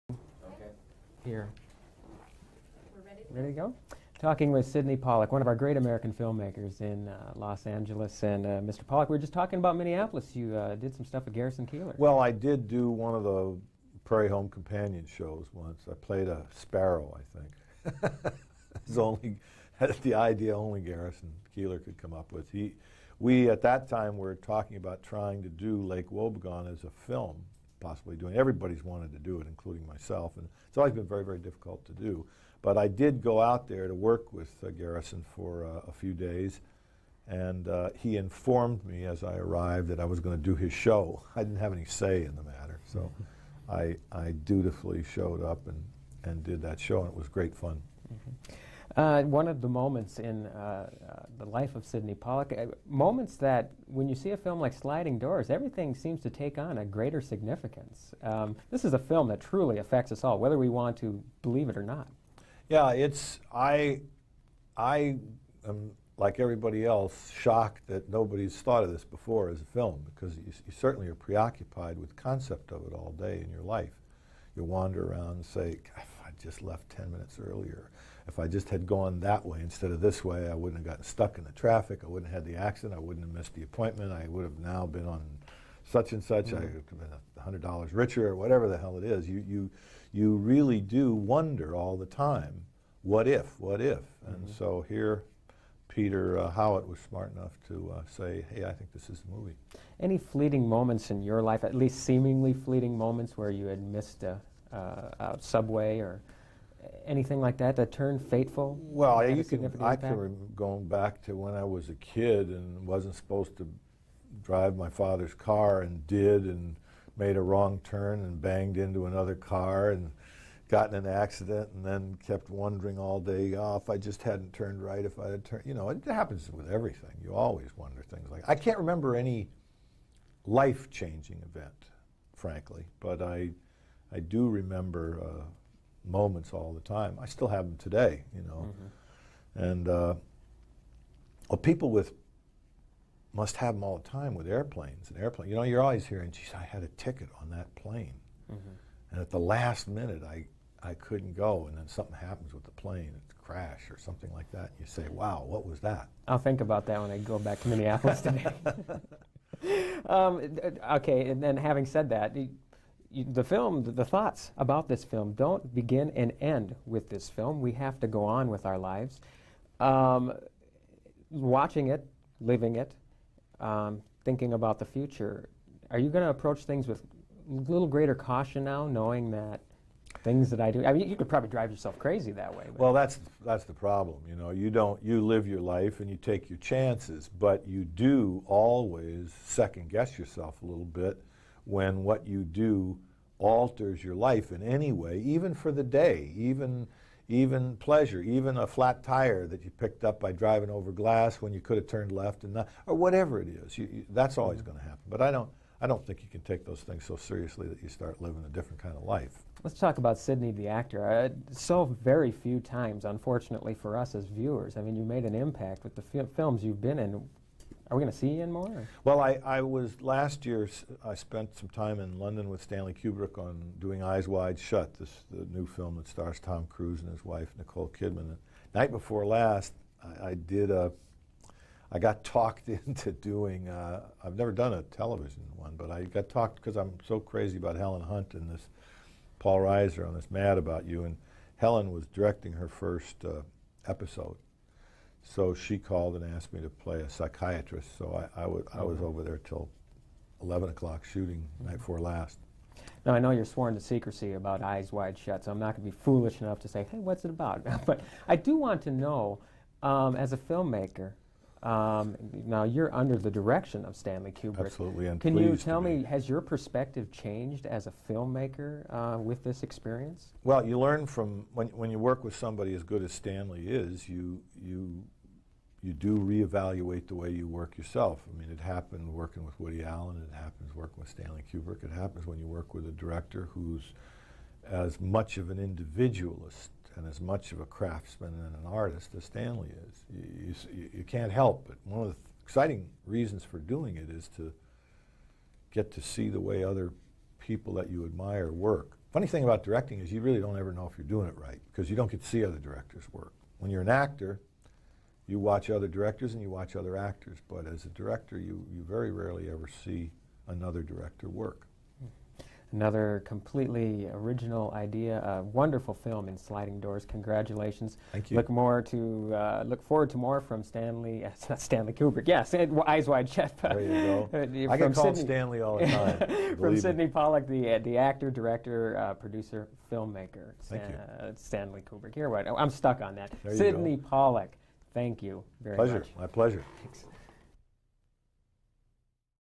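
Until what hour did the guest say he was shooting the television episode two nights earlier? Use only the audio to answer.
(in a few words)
11 o'clock.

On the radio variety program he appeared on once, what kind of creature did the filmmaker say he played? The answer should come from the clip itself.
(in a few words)
A sparrow.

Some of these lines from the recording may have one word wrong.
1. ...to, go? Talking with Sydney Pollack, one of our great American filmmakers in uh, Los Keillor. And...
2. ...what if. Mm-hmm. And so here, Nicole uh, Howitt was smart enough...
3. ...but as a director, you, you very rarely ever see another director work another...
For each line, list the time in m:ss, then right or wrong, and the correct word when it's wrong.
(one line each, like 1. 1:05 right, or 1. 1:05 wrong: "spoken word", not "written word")
1. 0:03 wrong: "Angeles", not "Keillor"
2. 1:33 wrong: "Peter", not "Nicole"
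3. 5:07 right.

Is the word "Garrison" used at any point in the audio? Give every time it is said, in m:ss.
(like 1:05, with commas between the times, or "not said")
0:11, 0:20, 0:34.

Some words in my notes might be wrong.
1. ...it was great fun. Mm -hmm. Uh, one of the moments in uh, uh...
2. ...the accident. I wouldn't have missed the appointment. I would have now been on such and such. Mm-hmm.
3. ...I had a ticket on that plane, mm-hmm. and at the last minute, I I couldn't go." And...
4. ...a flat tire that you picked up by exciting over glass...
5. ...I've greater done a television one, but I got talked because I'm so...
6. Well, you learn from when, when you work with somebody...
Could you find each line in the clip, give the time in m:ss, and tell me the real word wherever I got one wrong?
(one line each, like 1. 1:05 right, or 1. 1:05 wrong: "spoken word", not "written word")
1. 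0:47 right
2. 1:22 right
3. 2:26 right
4. 3:18 wrong: "driving", not "exciting"
5. 3:54 wrong: "never", not "greater"
6. 4:30 right.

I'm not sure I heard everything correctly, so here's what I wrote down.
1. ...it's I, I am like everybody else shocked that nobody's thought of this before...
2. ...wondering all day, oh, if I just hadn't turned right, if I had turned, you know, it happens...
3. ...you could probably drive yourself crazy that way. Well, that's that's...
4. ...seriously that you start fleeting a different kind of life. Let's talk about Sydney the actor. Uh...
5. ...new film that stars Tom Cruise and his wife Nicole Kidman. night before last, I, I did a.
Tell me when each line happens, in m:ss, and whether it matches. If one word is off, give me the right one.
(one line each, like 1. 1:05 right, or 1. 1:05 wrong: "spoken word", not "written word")
1. 1:02 right
2. 2:02 right
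3. 3:01 right
4. 3:27 wrong: "living", not "fleeting"
5. 3:45 right.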